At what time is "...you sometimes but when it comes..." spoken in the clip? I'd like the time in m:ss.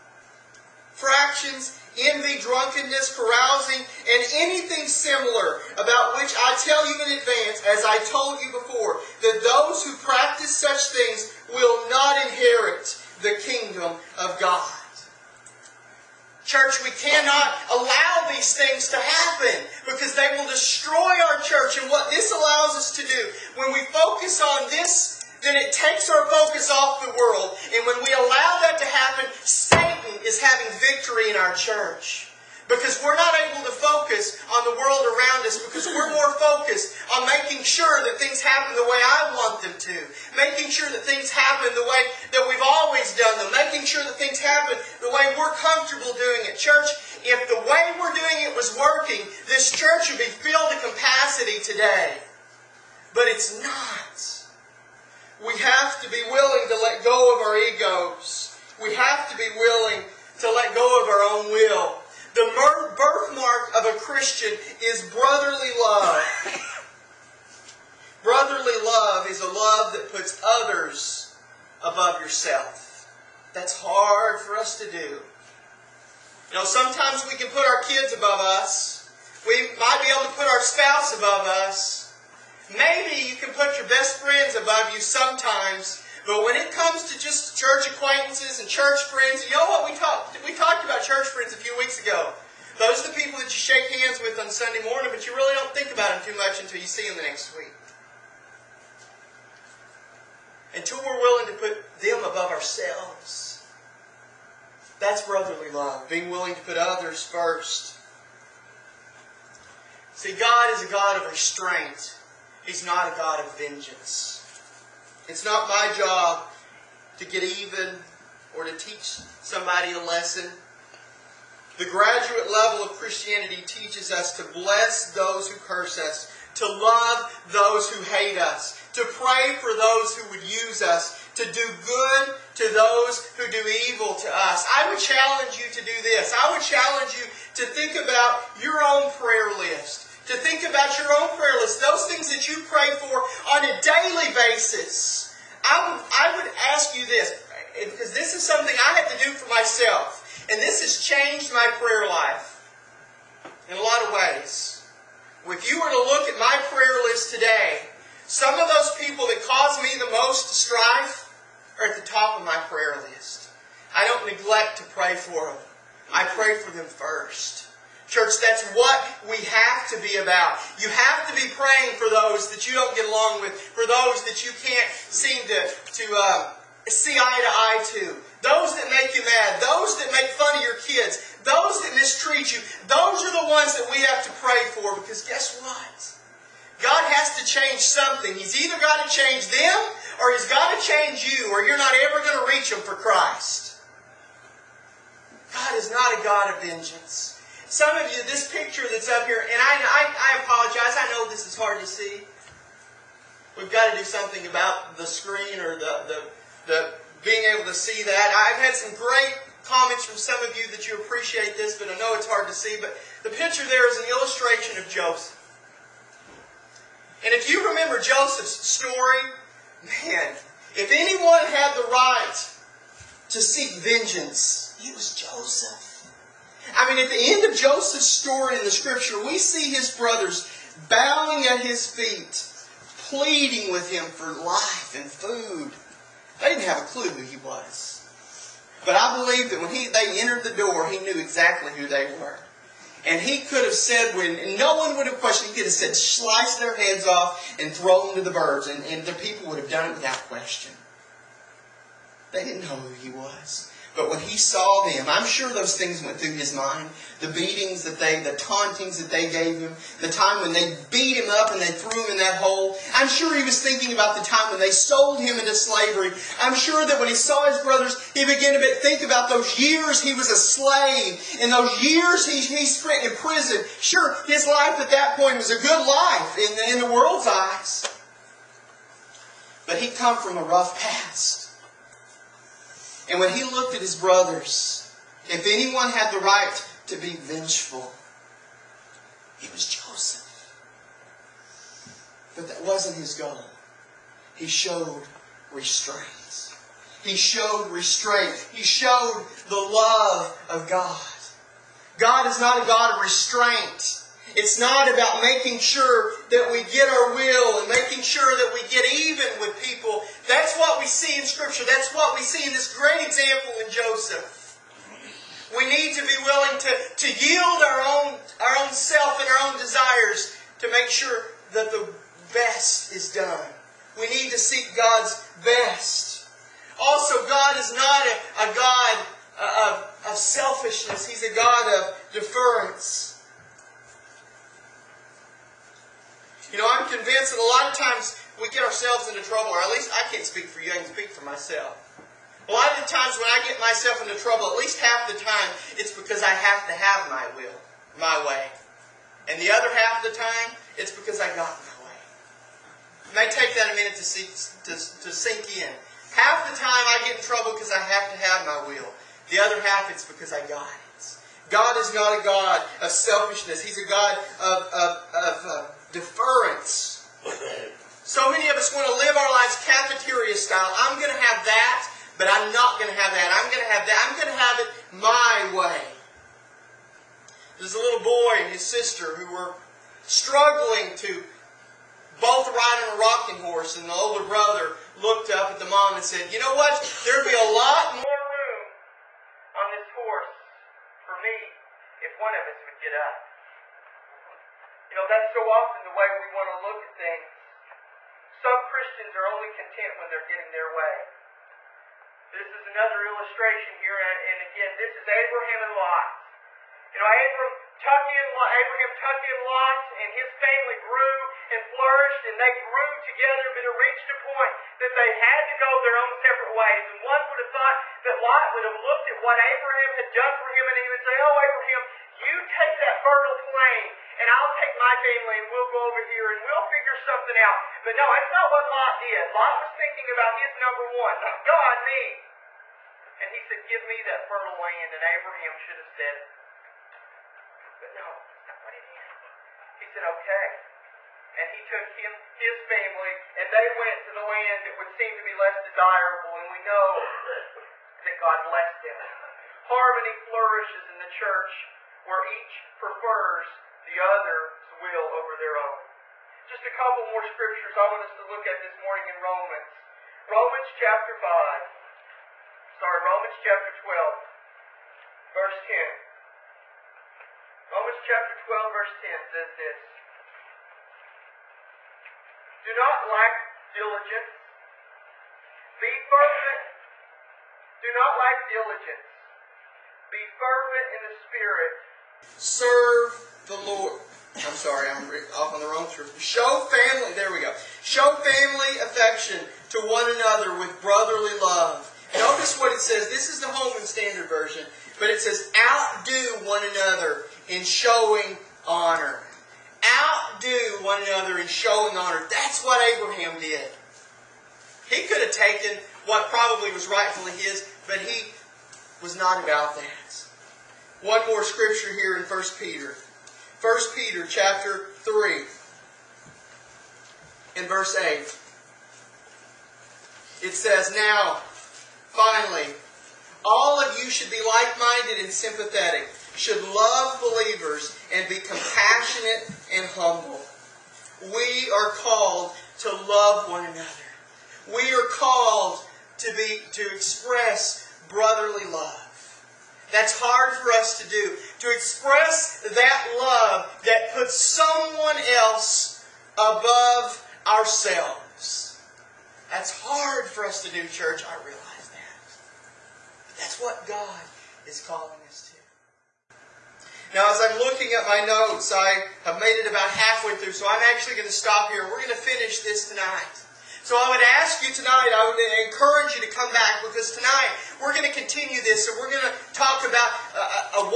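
1:24.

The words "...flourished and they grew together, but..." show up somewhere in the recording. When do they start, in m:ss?
6:51.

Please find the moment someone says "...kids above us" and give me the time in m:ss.
1:17.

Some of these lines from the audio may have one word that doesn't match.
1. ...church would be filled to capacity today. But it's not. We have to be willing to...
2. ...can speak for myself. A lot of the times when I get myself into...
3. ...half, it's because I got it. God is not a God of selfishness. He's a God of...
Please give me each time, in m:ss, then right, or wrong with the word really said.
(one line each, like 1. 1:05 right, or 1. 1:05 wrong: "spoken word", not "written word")
1. 0:49 right
2. 5:40 right
3. 5:59 right.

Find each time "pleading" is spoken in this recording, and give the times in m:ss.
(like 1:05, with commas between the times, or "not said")
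3:53.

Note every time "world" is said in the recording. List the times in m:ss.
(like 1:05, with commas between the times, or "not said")
0:27, 0:34, 4:36.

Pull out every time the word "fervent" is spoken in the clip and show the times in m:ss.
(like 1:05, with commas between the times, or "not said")
7:56, 8:00.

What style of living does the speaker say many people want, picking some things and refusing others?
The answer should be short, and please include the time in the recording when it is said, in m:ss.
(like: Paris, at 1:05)
Cafeteria style, at 6:09.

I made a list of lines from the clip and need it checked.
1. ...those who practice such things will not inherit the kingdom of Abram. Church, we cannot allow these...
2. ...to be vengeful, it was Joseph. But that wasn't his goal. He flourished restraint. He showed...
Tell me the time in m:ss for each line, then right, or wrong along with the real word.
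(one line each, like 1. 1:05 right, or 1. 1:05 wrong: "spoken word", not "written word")
1. 0:09 wrong: "God", not "Abram"
2. 4:46 wrong: "showed", not "flourished".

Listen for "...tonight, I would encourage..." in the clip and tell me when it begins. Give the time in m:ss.
9:24.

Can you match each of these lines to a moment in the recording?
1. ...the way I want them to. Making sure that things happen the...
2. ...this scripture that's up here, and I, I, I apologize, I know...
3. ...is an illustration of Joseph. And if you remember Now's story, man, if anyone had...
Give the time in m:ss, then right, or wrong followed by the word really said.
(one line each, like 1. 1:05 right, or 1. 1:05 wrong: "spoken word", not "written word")
1. 0:38 right
2. 3:18 wrong: "picture", not "scripture"
3. 3:33 wrong: "Joseph", not "Now".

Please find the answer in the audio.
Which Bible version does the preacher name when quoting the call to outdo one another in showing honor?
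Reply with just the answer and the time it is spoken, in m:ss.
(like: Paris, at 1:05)
Holman Standard Version, at 8:13.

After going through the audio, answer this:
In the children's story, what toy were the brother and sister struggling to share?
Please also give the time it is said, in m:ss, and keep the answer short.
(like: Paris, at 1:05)
A rocking horse, at 6:23.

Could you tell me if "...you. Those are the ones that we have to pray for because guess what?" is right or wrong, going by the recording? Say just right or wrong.
right.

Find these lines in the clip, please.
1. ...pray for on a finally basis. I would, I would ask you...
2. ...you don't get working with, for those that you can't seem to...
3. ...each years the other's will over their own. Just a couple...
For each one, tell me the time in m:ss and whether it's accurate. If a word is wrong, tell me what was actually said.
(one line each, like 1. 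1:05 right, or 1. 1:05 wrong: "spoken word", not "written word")
1. 2:22 wrong: "daily", not "finally"
2. 2:52 wrong: "along", not "working"
3. 7:32 wrong: "prefers", not "years".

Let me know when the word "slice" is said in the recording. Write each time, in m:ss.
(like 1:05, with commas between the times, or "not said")
4:05.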